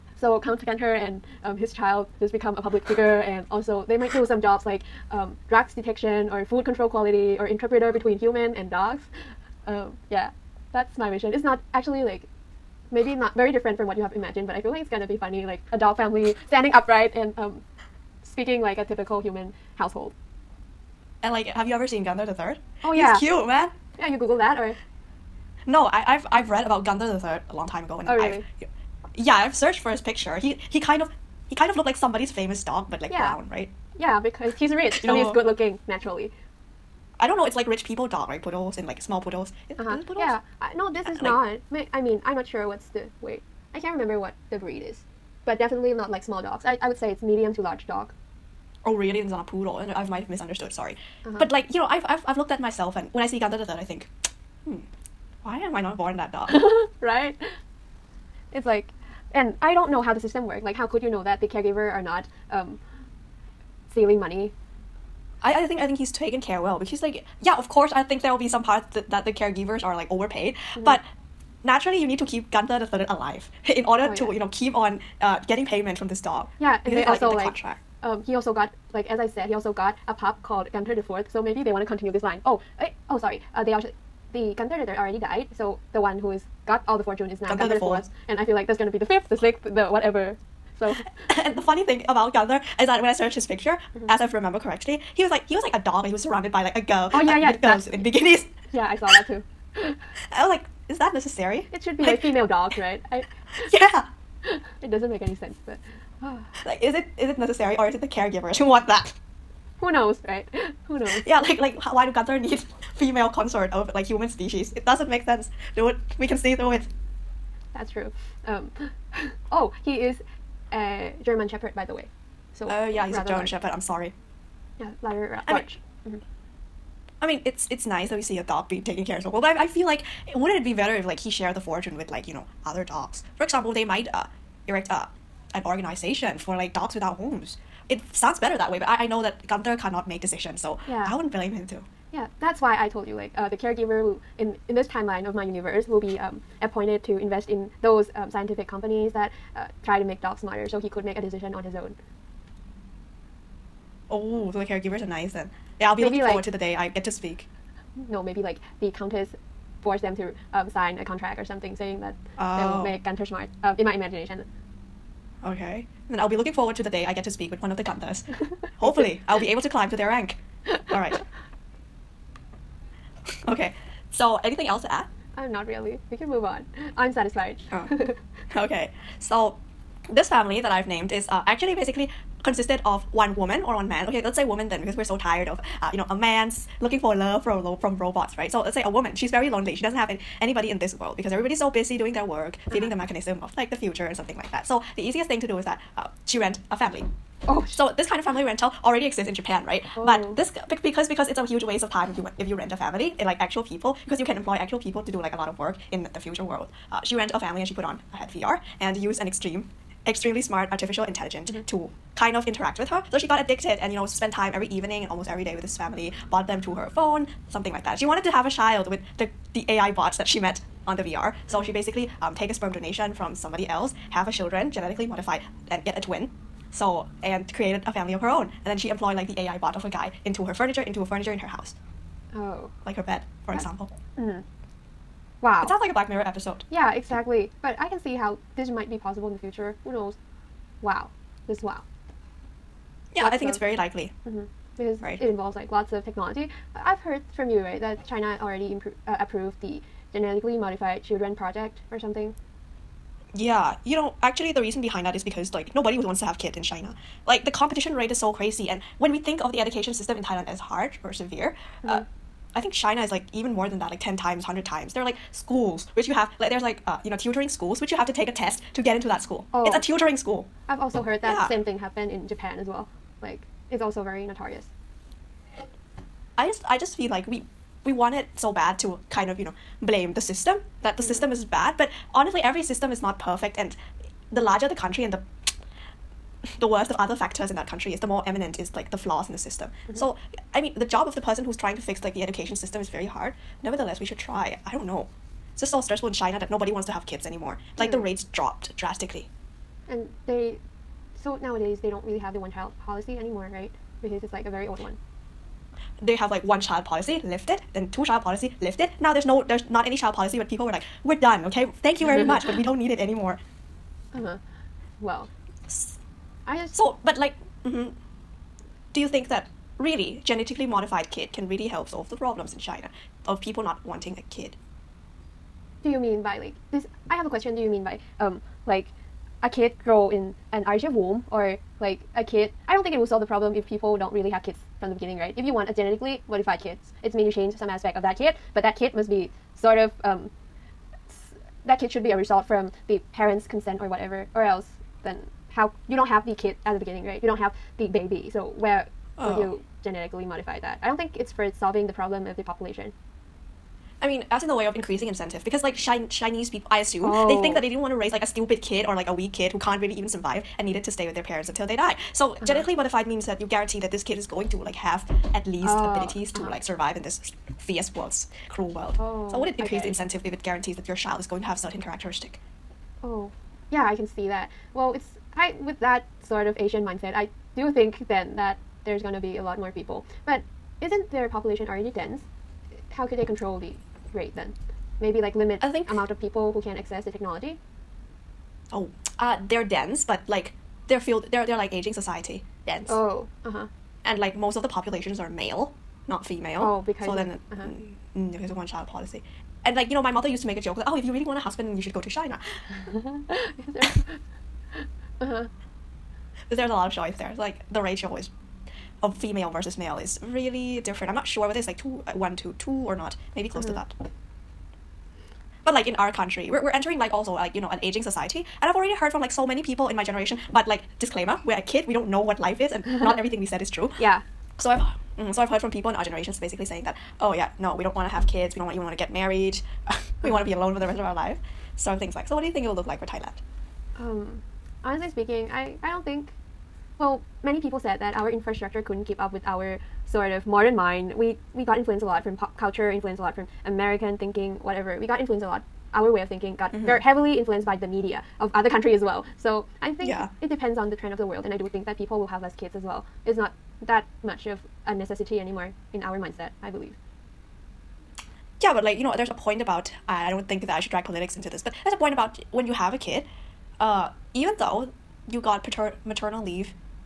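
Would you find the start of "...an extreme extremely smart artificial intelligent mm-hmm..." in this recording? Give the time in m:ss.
3:29.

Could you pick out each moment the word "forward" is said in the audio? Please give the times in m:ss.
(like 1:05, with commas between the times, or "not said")
2:36, 2:46.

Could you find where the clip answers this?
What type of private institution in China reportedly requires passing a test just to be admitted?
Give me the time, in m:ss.
4:27.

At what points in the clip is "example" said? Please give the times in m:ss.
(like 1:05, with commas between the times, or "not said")
2:13, 3:53.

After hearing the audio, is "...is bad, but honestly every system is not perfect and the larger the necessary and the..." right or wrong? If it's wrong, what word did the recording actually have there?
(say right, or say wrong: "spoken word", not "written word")
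wrong: "country", not "necessary".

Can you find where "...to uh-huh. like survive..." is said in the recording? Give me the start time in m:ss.
6:06.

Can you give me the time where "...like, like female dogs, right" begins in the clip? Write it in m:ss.
1:42.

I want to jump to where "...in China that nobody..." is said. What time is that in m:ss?
4:56.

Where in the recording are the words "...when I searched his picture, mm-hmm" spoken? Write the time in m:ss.
1:33.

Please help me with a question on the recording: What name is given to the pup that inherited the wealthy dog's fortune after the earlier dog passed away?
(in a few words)
Gunter the Fourth.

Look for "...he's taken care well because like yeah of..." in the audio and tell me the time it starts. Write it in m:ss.
1:05.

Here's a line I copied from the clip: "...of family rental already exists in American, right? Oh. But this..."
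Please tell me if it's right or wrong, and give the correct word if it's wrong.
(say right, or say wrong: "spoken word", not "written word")
wrong: "Japan", not "American".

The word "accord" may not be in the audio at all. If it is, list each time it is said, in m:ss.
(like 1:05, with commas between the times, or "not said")
not said.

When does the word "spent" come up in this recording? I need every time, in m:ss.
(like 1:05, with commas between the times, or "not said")
3:34.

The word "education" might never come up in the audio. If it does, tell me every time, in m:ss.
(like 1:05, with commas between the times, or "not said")
4:19, 4:52.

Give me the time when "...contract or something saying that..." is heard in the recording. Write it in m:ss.
2:41.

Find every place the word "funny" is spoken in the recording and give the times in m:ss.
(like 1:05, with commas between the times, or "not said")
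0:15, 1:31.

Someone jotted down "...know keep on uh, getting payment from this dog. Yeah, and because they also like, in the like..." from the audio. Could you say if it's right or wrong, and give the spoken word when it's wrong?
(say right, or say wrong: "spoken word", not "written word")
right.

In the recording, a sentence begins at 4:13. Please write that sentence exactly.
Yeah, you know, actually, the reason behind that is because like nobody wants to have kid in China.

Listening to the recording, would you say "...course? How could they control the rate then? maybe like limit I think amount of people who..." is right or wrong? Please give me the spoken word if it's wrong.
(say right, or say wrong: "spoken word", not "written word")
wrong: "dense", not "course".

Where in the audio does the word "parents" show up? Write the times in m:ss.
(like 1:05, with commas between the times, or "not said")
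5:43, 6:01.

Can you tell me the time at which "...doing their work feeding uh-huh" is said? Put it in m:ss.
3:11.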